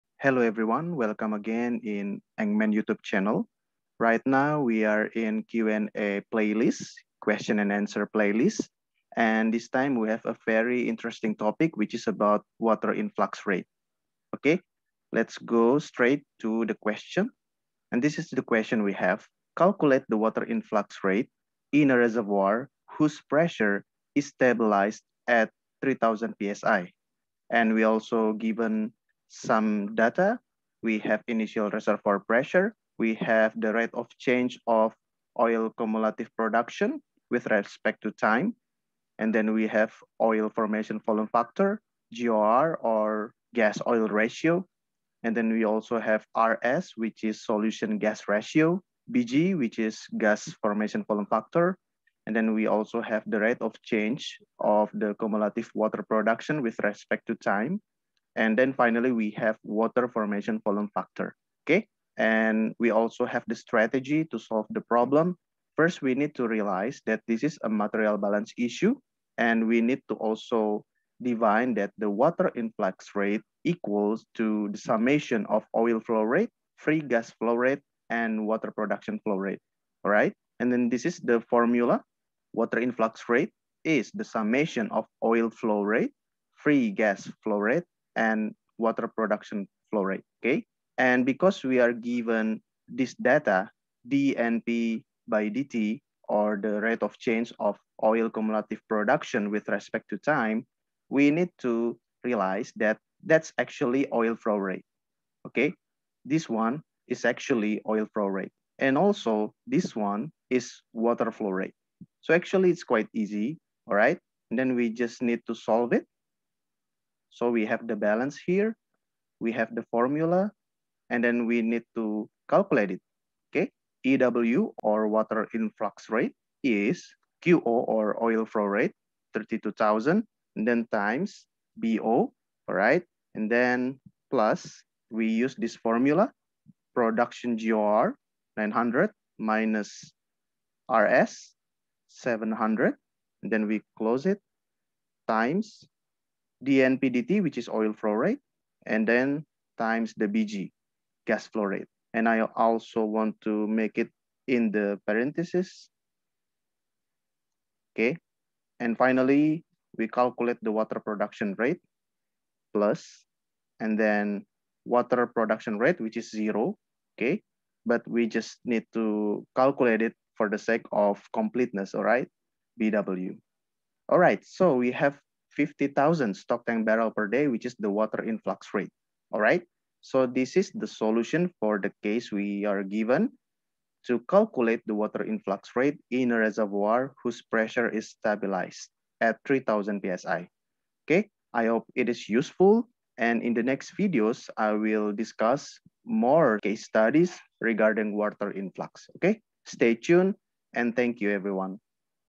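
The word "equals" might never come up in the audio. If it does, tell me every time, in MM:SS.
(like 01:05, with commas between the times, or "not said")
01:13.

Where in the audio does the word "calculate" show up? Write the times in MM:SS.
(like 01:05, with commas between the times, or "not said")
00:19, 02:02, 02:40, 02:49, 03:04.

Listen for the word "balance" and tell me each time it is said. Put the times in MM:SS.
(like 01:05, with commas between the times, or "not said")
01:08, 01:57.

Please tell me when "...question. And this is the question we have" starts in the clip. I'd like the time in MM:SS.
00:16.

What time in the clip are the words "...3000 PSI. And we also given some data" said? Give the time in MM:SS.
00:25.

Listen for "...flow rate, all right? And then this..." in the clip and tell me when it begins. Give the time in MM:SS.
01:19.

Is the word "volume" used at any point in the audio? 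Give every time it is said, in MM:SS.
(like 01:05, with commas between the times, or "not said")
00:40, 00:51, 01:00.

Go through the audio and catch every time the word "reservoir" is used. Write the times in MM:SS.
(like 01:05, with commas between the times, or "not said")
00:21, 00:31, 03:06.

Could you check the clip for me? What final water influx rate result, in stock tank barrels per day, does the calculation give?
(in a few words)
50,000.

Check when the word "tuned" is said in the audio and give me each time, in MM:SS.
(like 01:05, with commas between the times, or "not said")
03:19.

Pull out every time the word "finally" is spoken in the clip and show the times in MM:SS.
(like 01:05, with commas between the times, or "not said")
00:58, 02:38.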